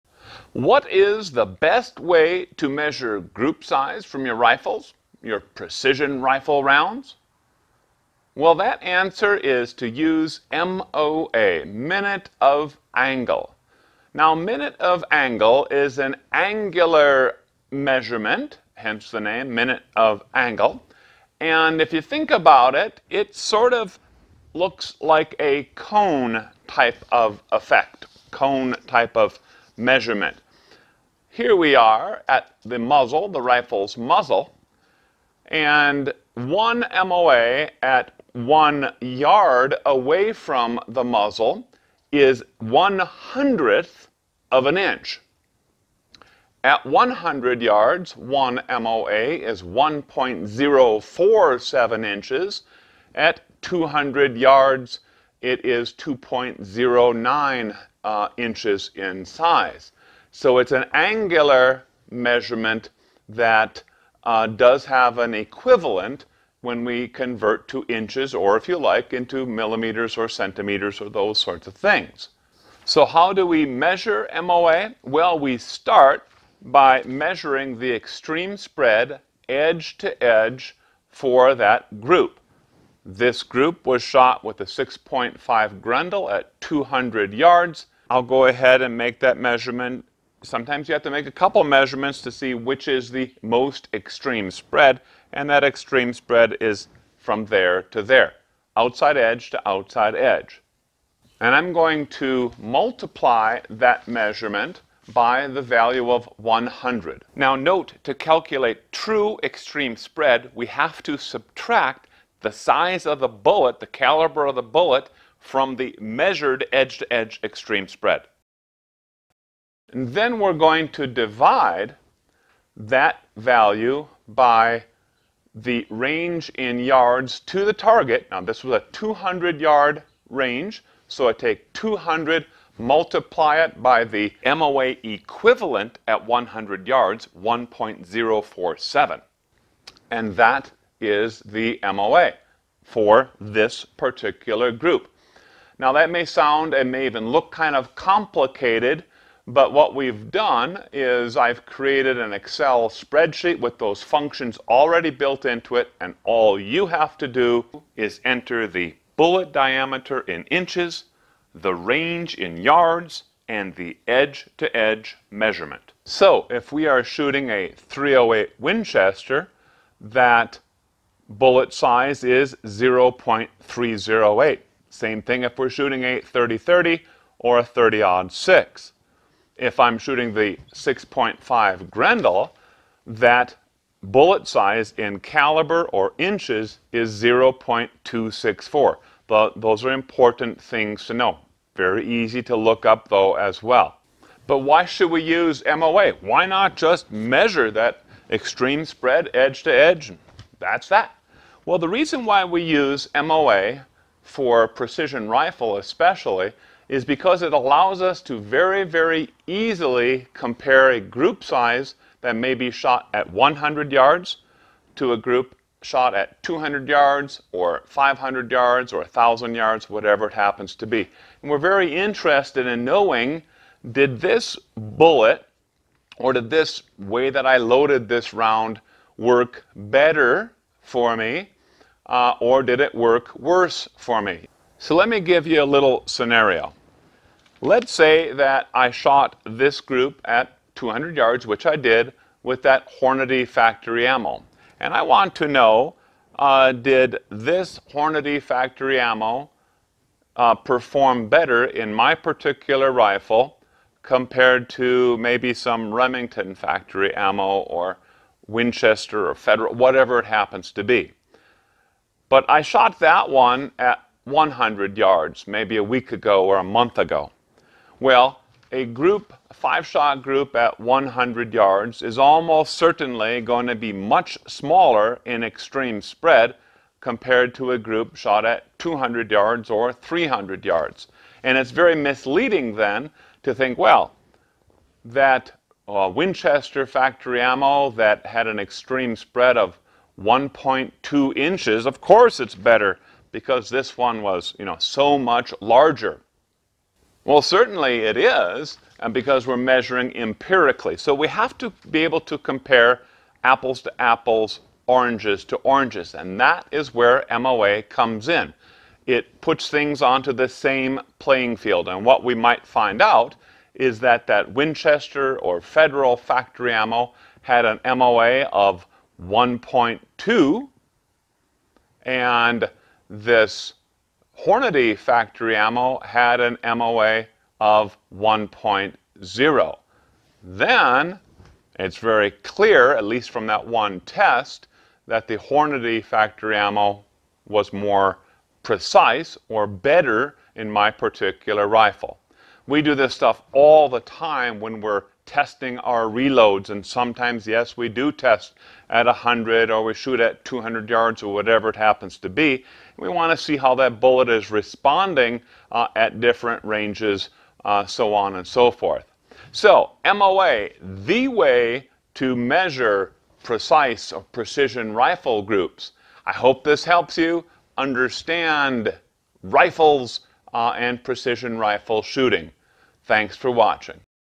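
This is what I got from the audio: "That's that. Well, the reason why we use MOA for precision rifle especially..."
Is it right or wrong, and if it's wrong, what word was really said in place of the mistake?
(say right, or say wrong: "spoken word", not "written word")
right.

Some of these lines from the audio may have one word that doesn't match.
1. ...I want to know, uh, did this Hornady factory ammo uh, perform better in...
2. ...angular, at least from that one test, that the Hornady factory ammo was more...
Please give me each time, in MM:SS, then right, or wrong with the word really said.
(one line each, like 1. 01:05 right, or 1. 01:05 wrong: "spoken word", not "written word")
1. 04:04 right
2. 05:32 wrong: "clear", not "angular".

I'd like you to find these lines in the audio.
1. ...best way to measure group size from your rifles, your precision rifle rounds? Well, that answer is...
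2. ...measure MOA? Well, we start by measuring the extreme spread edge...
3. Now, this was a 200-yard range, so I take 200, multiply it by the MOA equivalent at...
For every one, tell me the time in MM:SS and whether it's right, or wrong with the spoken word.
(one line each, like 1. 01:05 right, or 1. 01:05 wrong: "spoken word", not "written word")
1. 00:01 right
2. 01:13 right
3. 02:08 right.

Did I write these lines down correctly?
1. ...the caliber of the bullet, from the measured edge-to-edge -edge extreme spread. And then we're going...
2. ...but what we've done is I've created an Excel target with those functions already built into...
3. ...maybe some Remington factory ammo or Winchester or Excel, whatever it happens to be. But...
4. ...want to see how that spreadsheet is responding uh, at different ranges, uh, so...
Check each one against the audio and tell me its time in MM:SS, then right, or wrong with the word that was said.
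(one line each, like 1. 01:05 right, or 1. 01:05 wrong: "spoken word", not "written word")
1. 01:53 right
2. 02:29 wrong: "spreadsheet", not "target"
3. 04:15 wrong: "Federal", not "Excel"
4. 05:53 wrong: "bullet", not "spreadsheet".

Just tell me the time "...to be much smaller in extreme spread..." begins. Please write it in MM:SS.
04:33.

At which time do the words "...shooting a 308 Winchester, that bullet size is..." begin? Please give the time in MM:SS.
02:47.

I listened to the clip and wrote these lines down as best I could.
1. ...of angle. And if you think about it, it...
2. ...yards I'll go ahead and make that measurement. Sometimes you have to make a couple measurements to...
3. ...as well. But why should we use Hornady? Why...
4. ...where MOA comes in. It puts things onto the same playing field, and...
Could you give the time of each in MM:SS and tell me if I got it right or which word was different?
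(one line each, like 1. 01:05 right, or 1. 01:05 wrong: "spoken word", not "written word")
1. 00:19 right
2. 01:27 right
3. 03:13 wrong: "MOA", not "Hornady"
4. 05:06 right.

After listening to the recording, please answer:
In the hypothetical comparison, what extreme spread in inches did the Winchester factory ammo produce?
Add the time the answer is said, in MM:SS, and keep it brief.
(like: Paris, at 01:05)
1.2 inches, at 04:50.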